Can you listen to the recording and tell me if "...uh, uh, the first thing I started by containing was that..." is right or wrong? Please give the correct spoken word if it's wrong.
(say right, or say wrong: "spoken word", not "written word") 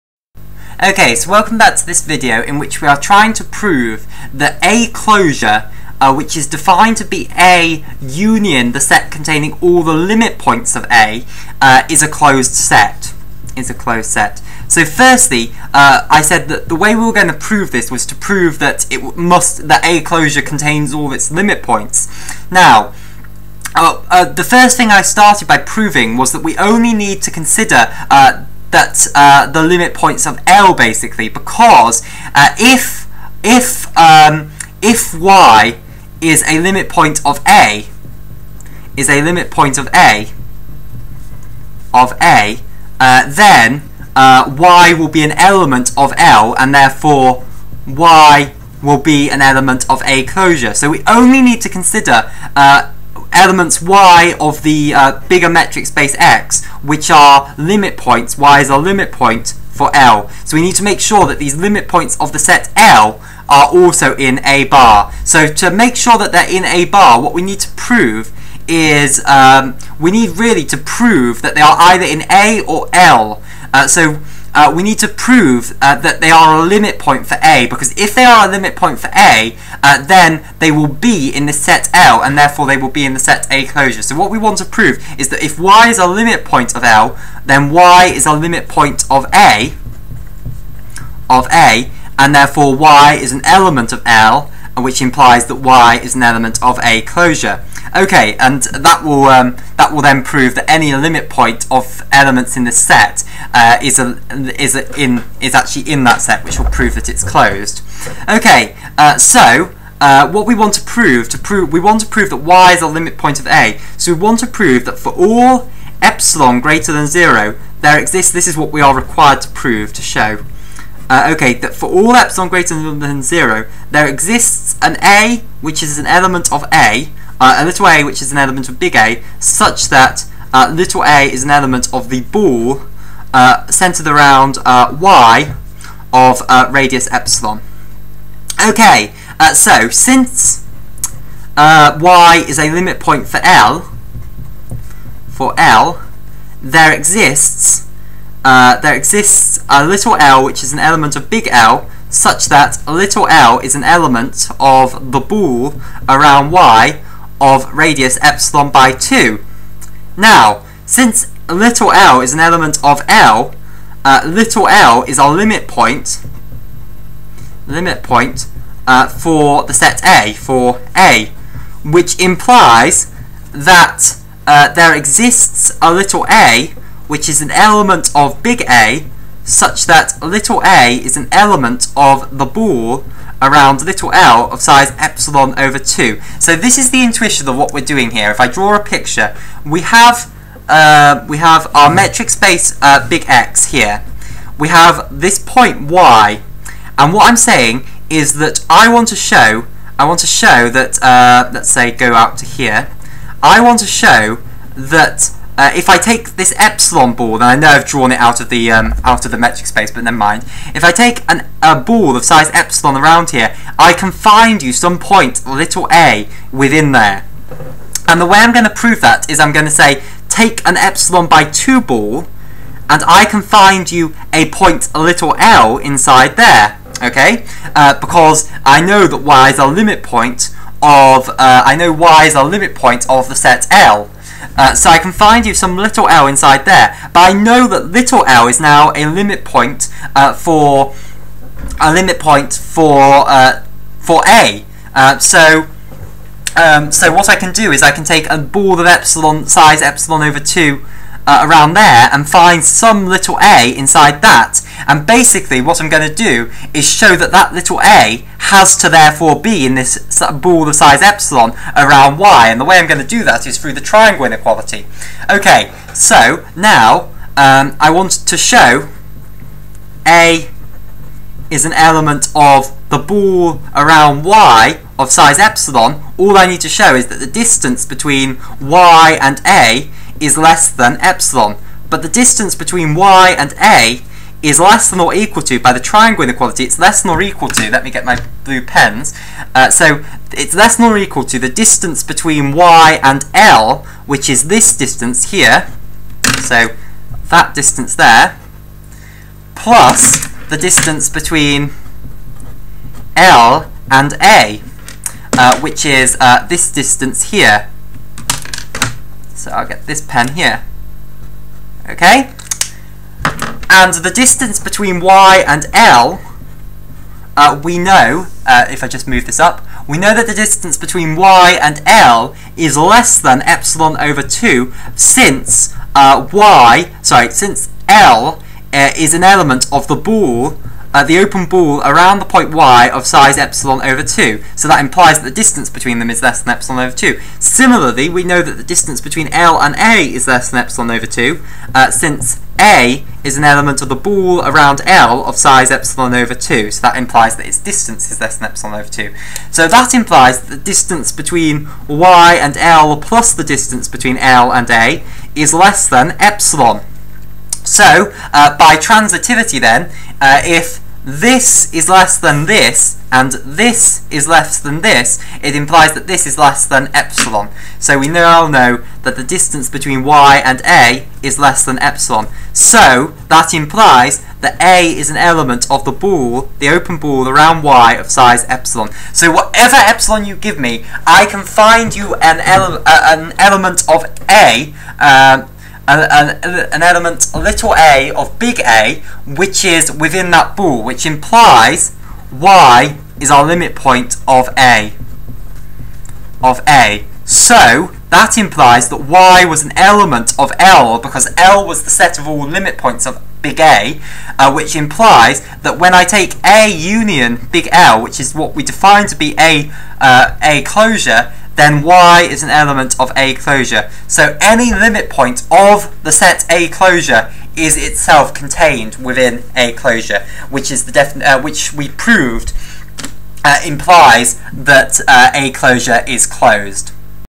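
wrong: "proving", not "containing".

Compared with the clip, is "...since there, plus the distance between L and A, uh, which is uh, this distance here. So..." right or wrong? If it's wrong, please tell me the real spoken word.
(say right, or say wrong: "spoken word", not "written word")
wrong: "distance", not "since".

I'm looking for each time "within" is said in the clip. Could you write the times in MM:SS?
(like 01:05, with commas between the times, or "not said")
03:36, 06:29, 06:58.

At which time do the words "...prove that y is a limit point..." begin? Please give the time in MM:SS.
01:52.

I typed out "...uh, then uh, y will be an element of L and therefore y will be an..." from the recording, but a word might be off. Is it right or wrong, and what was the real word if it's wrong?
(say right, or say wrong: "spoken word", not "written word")
right.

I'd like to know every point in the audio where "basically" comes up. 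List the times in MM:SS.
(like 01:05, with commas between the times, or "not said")
00:30, 04:15.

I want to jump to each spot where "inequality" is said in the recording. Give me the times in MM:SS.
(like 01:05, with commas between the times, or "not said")
04:24, 04:46.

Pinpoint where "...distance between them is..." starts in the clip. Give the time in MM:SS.
05:35.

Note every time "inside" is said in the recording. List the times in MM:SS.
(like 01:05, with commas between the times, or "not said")
03:45, 03:56, 04:13.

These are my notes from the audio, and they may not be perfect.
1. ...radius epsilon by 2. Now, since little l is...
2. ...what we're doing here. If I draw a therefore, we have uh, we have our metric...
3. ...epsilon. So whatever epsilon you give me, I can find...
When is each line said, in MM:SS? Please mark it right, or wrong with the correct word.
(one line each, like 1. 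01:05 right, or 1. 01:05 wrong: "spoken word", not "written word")
1. 02:37 right
2. 03:07 wrong: "picture", not "therefore"
3. 06:18 right.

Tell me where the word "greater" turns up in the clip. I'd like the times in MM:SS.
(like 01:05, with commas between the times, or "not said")
01:56, 02:02.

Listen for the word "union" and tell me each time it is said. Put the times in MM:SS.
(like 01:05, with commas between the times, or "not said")
00:08, 06:46.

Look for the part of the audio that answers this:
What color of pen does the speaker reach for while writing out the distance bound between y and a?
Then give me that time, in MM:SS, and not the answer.
04:48.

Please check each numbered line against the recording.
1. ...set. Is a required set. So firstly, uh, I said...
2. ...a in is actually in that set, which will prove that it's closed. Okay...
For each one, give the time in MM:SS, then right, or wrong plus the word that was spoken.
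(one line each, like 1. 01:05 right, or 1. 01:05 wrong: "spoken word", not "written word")
1. 00:12 wrong: "closed", not "required"
2. 01:44 right.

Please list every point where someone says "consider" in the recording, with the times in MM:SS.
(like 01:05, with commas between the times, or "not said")
00:27, 00:51.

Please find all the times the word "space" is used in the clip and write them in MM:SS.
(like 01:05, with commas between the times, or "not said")
00:55, 03:12, 03:29.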